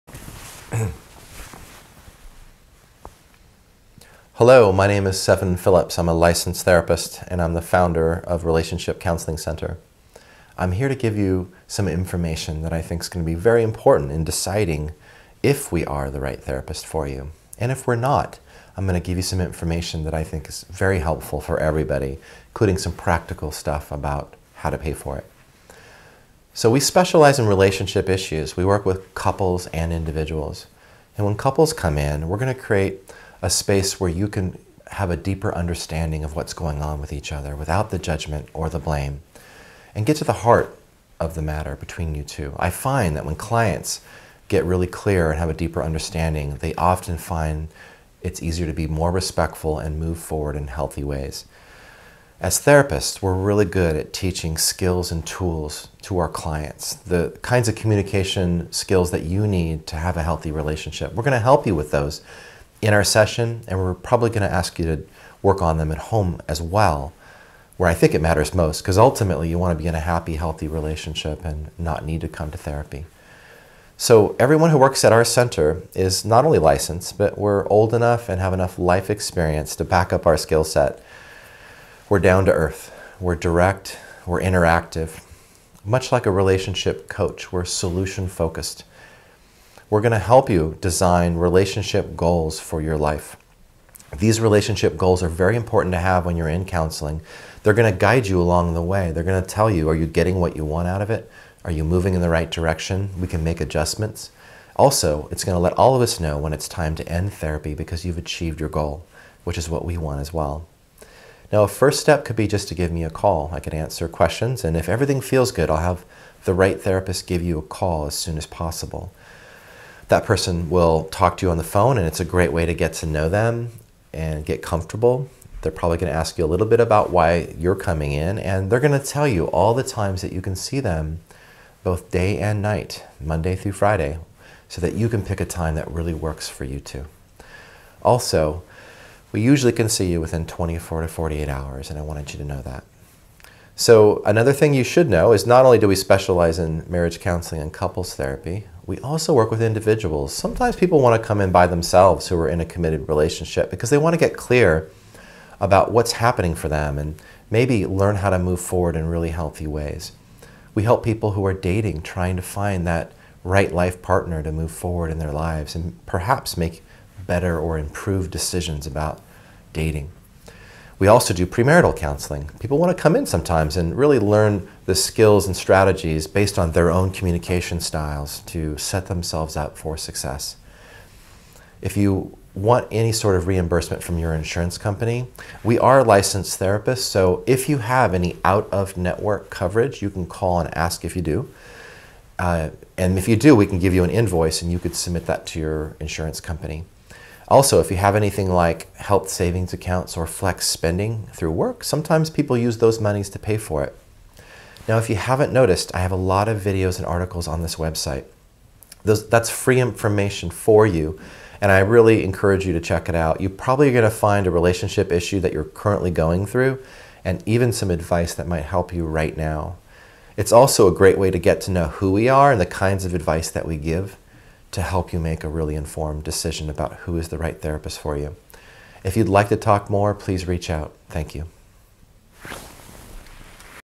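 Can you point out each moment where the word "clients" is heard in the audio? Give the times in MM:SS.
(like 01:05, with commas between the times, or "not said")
00:43, 00:56.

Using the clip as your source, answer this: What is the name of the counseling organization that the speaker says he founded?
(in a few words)
Relationship Counseling Center.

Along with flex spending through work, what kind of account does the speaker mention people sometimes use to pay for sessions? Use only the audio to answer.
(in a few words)
Health savings accounts.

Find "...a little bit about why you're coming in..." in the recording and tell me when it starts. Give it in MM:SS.
02:06.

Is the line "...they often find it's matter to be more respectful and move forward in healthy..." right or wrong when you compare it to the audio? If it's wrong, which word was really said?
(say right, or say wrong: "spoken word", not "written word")
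wrong: "easier", not "matter".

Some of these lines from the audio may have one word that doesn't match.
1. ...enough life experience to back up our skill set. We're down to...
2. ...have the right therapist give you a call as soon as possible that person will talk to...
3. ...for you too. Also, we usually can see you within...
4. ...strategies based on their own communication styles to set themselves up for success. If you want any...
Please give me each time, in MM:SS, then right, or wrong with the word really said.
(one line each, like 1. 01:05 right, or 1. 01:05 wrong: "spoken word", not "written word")
1. 01:18 right
2. 01:55 right
3. 02:16 right
4. 02:55 right.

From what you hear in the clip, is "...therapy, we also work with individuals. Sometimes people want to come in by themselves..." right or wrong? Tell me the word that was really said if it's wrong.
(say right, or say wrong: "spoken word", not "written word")
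right.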